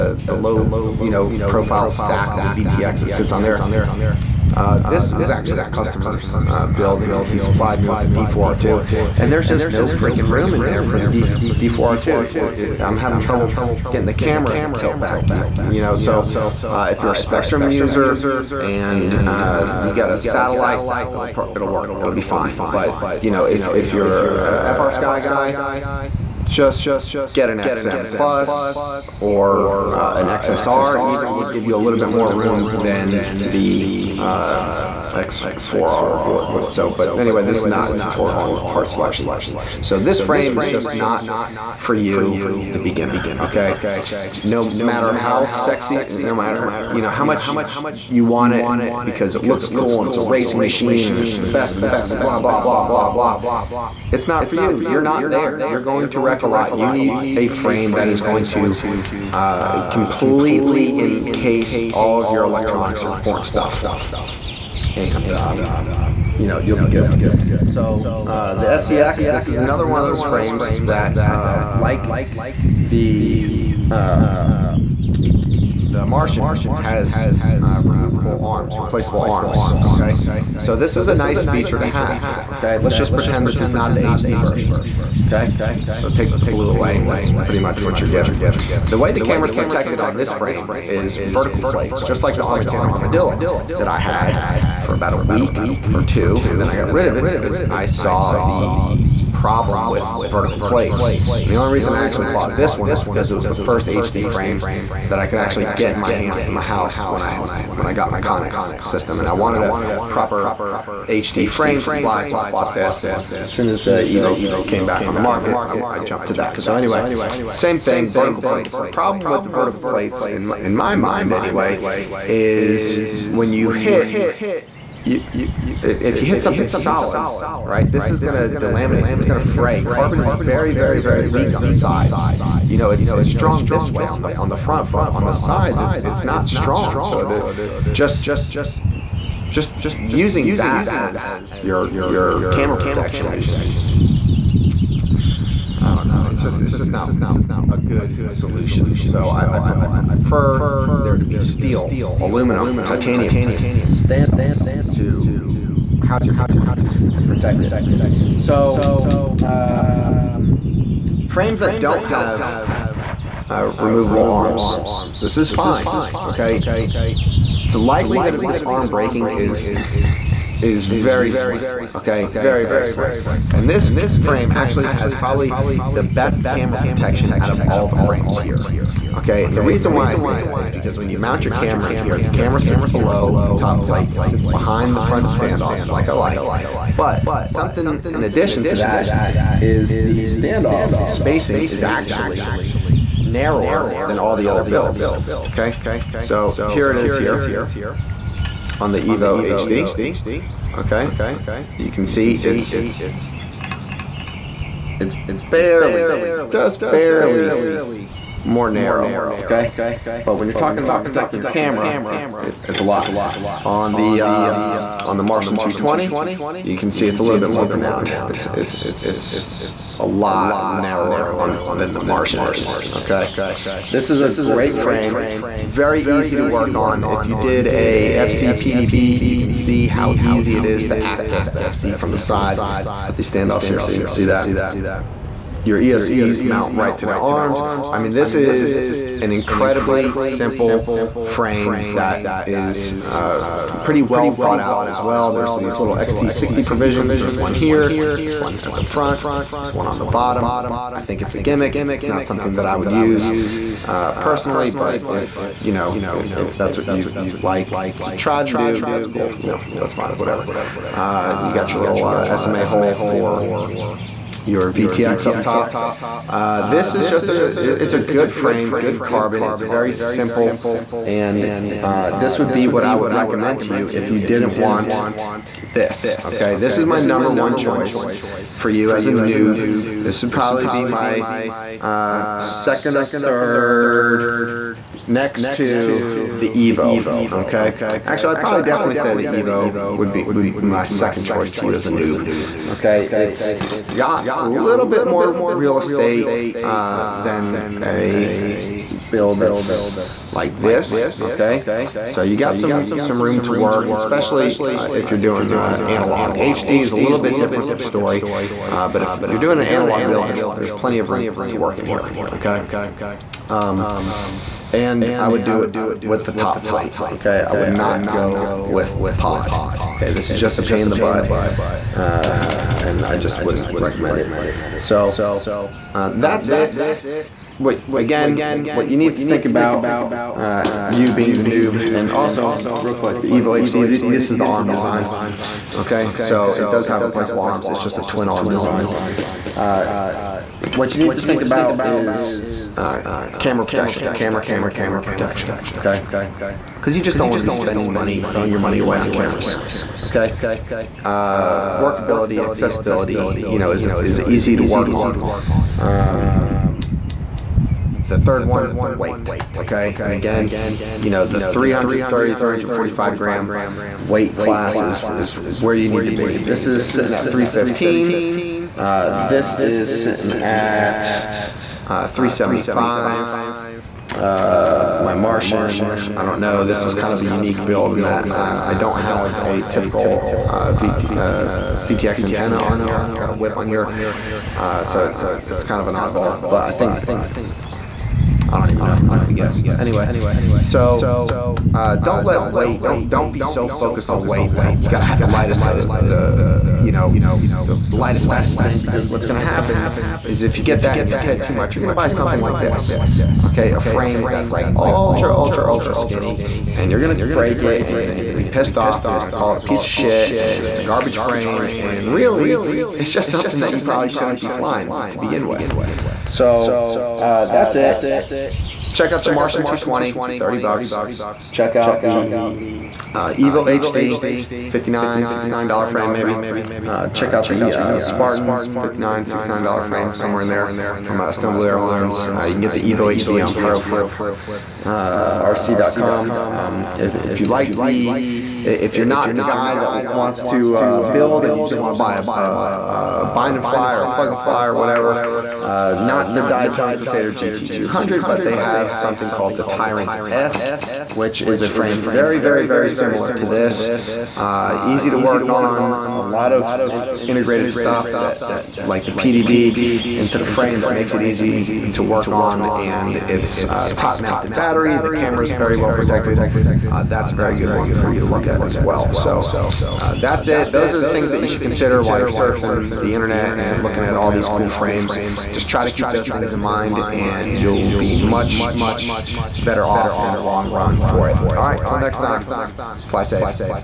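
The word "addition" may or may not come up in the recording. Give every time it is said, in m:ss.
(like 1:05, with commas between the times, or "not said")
3:08.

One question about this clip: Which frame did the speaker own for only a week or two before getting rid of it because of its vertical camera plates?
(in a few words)
Armattan Armadillo.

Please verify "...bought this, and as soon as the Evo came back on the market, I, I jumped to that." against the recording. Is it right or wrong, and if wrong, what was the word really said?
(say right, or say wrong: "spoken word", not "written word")
right.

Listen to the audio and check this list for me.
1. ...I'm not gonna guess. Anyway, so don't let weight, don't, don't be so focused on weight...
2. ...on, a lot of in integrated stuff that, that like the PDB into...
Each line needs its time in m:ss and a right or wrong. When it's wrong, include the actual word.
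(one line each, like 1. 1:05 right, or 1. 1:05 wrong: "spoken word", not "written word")
1. 6:28 right
2. 7:35 right.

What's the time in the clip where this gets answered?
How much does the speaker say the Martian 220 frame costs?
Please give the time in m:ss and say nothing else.
7:00.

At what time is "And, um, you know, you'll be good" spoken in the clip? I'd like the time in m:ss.
1:04.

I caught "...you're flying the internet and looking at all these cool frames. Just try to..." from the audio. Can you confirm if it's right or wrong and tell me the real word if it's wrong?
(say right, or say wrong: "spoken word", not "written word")
wrong: "surfing", not "flying".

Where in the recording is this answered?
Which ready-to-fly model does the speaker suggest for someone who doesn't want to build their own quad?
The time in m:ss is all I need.
7:29.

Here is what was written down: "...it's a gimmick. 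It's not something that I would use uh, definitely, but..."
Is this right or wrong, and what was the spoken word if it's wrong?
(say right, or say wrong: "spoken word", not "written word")
wrong: "personally", not "definitely".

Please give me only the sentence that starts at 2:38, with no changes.
So um, frames that don't have uh, removable arms, this is fine, okay?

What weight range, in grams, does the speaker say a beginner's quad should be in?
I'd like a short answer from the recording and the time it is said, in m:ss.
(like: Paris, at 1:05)
330 to 345 grams, at 6:01.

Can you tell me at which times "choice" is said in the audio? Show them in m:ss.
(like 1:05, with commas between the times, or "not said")
4:37, 4:51.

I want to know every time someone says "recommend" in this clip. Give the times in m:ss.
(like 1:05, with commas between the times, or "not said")
4:33, 5:23.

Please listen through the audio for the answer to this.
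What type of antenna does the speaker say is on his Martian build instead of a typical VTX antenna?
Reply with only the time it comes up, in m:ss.
6:23.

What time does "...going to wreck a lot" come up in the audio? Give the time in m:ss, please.
0:55.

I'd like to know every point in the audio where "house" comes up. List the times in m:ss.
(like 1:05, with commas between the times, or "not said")
1:46, 2:36.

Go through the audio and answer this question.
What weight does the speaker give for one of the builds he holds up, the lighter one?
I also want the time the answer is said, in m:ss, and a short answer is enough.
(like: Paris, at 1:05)
315 grams, at 6:07.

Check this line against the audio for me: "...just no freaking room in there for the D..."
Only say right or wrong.
right.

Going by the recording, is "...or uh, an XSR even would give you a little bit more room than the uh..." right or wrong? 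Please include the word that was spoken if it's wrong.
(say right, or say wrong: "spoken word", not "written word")
right.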